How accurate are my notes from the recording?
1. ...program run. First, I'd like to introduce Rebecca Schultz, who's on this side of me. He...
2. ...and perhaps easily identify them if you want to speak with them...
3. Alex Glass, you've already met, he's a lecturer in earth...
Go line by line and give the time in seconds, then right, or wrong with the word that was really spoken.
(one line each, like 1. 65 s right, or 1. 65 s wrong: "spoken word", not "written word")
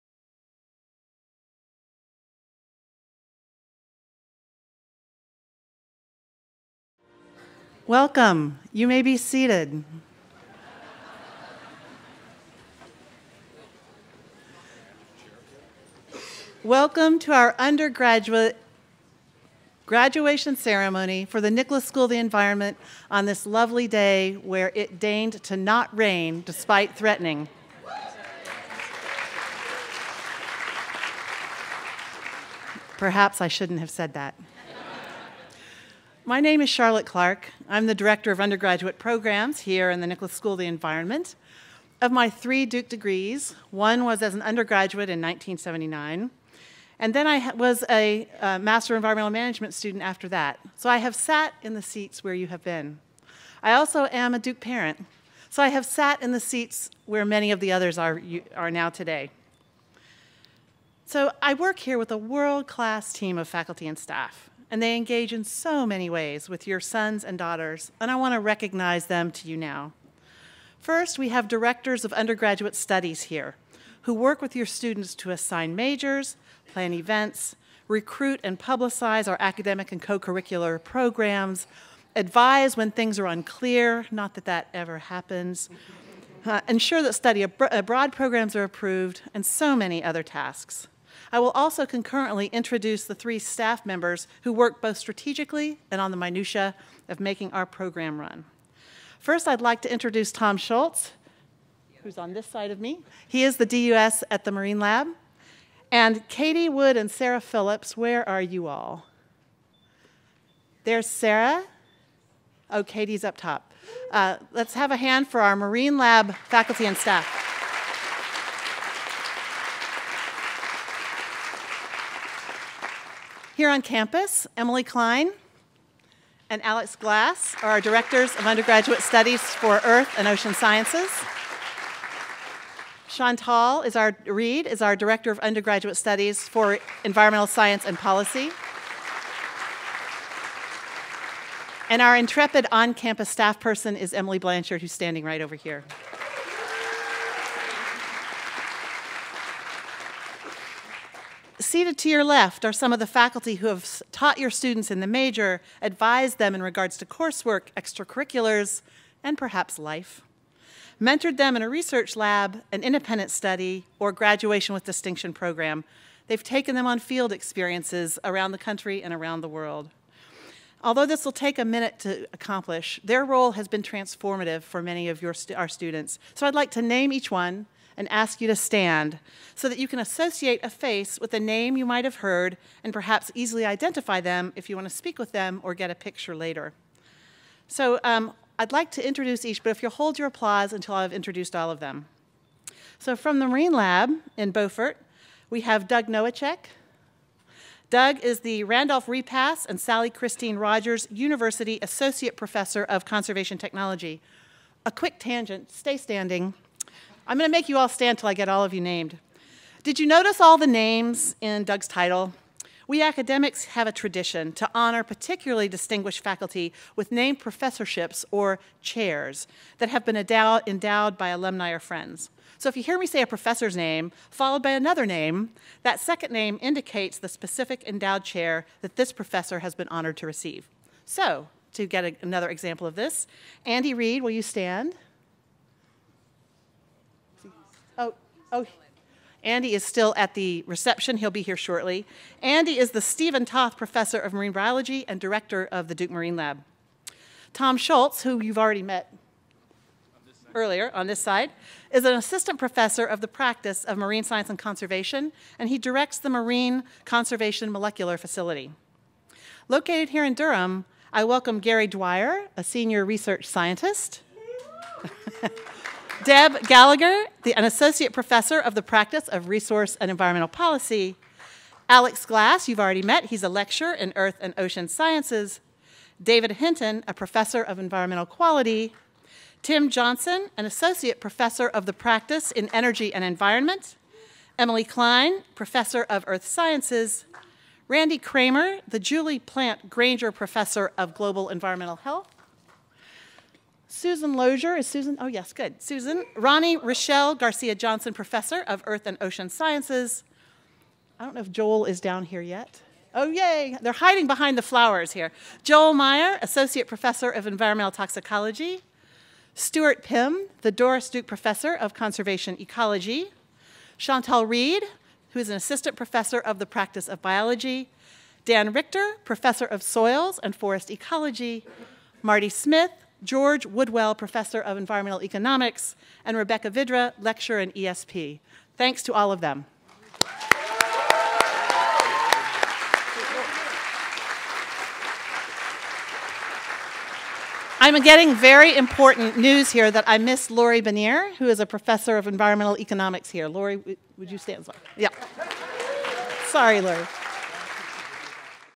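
1. 97 s wrong: "Tom", not "Rebecca"
2. 182 s right
3. 271 s right.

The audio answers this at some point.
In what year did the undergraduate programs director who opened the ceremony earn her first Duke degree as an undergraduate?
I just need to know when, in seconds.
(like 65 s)
45 s.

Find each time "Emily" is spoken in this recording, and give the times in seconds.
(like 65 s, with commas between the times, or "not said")
124 s, 144 s, 284 s.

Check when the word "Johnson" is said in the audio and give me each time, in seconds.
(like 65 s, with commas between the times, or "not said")
279 s, 297 s.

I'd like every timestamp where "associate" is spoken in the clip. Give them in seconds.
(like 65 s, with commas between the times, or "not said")
179 s, 201 s, 267 s, 280 s, 306 s.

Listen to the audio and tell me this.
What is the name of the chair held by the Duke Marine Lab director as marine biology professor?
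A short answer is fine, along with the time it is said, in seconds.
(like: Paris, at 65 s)
Stephen Toth, at 243 s.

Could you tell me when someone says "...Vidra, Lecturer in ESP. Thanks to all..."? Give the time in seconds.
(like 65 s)
326 s.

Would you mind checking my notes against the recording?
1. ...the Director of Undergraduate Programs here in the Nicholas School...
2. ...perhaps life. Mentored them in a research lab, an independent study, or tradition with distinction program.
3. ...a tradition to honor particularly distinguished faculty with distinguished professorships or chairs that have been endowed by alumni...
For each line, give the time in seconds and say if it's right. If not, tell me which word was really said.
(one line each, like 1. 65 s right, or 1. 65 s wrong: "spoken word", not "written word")
1. 37 s right
2. 159 s wrong: "graduation", not "tradition"
3. 213 s wrong: "named", not "distinguished".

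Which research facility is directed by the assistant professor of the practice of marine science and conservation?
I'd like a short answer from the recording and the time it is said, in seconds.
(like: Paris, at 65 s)
Marine Conservation Molecular Facility, at 256 s.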